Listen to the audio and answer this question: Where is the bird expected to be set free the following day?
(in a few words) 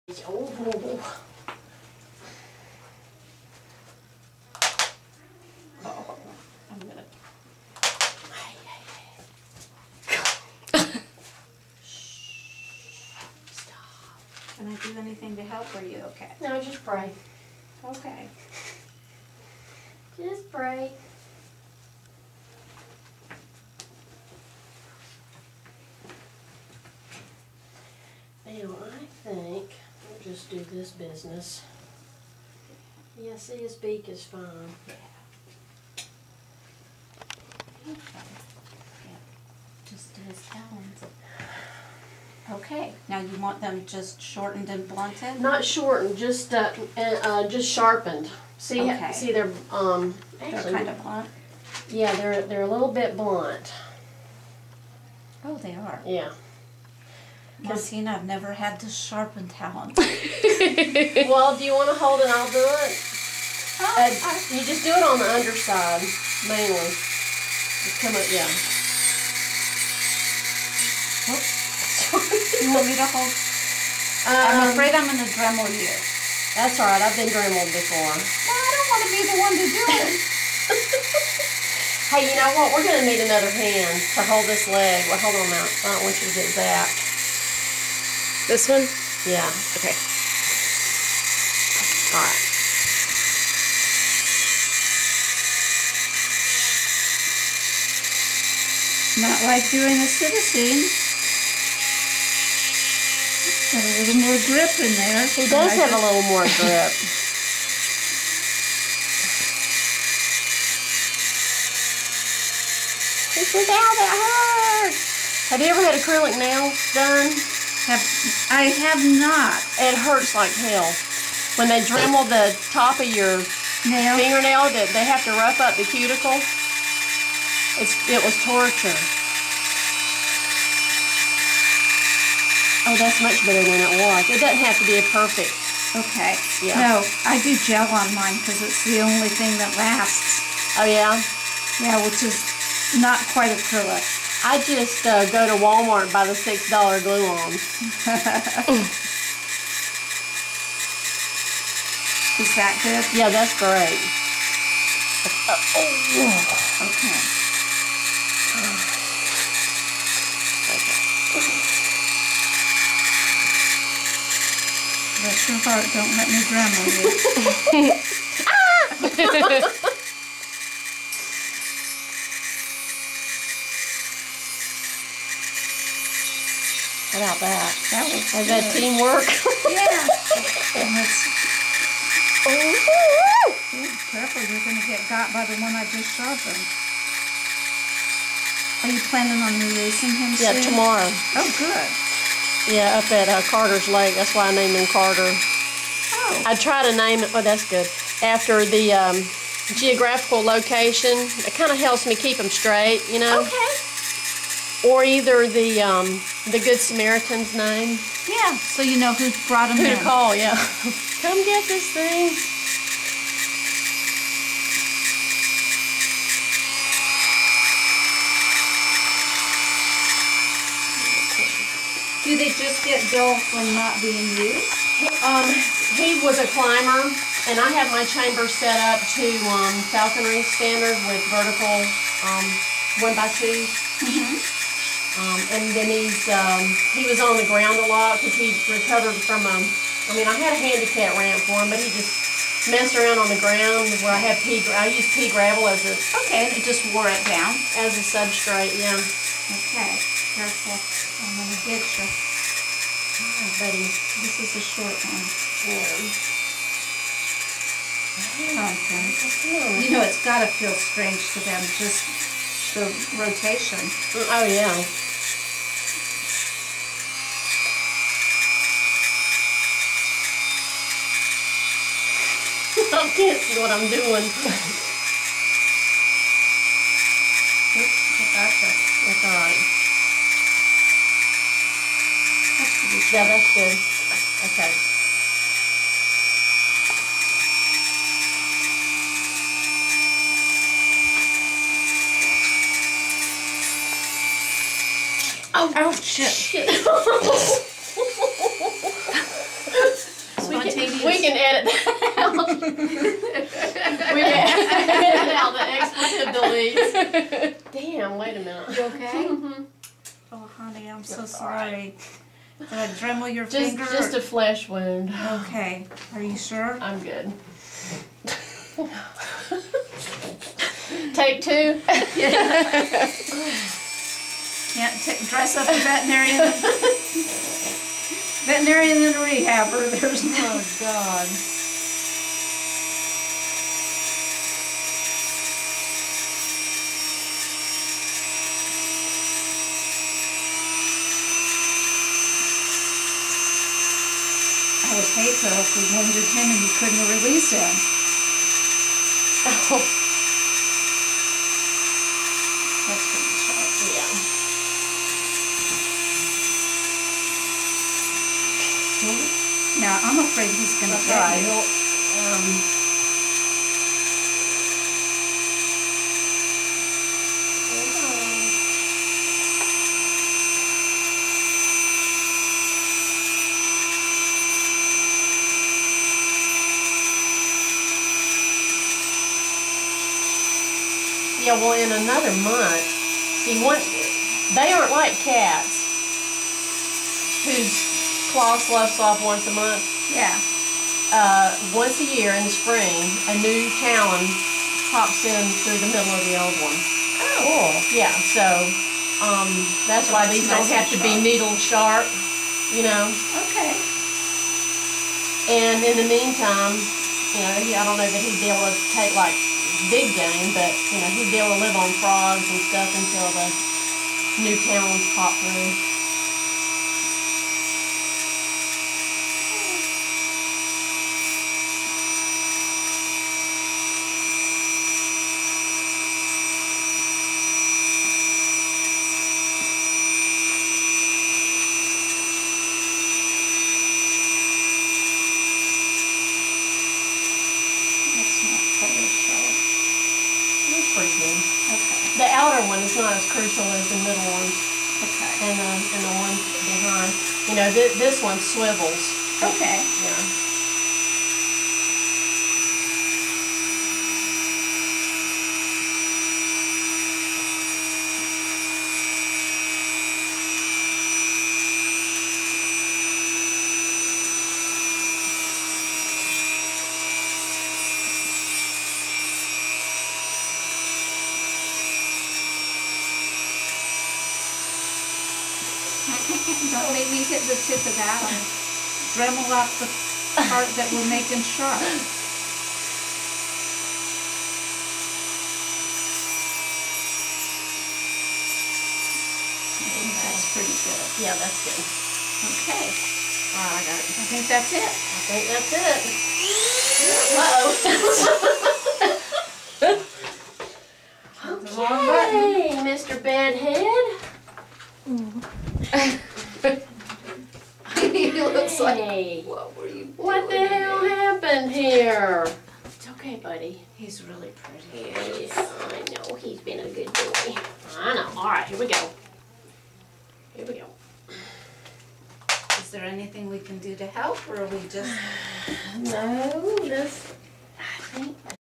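Carter's Lake.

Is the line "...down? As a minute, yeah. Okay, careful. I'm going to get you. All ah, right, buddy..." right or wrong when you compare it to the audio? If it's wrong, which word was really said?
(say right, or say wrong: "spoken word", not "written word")
wrong: "substrate", not "minute".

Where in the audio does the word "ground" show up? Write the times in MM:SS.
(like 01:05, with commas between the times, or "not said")
03:57, 04:03.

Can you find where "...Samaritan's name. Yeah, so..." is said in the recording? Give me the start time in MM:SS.
03:26.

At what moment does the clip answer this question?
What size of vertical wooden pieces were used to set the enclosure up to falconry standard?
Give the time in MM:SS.
03:53.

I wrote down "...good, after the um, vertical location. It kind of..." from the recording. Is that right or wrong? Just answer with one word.
wrong.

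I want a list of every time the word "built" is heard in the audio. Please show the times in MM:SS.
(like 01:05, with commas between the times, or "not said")
03:43.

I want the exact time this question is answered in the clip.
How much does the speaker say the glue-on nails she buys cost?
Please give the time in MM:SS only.
02:26.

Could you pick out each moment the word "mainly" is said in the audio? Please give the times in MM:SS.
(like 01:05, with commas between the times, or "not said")
01:06.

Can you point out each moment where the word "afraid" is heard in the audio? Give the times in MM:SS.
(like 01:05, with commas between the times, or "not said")
01:14, 06:00.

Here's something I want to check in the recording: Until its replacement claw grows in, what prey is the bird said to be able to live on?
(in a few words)
frogs.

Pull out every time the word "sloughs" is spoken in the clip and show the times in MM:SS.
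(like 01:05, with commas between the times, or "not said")
06:28.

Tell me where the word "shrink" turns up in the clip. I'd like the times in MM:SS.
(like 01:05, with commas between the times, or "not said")
not said.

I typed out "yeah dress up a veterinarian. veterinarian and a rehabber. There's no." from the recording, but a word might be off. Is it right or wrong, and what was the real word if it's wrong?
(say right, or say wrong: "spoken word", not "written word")
right.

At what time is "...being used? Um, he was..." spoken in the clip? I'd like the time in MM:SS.
03:44.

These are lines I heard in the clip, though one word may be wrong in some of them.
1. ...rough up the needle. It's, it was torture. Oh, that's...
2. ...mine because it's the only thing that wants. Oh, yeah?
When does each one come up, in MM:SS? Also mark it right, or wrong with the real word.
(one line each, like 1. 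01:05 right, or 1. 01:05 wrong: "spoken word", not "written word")
1. 02:05 wrong: "cuticle", not "needle"
2. 02:18 wrong: "lasts", not "wants".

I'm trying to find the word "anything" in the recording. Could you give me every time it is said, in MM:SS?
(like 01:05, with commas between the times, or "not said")
00:14, 08:43.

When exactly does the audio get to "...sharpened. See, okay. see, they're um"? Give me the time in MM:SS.
00:47.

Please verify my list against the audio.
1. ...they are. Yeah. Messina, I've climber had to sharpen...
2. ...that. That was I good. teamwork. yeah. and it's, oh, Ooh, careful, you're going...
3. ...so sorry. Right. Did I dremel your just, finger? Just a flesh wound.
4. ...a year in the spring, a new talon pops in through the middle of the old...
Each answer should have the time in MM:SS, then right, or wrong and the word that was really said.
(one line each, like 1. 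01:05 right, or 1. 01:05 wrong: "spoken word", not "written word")
1. 00:55 wrong: "never", not "climber"
2. 02:57 right
3. 05:11 right
4. 06:31 right.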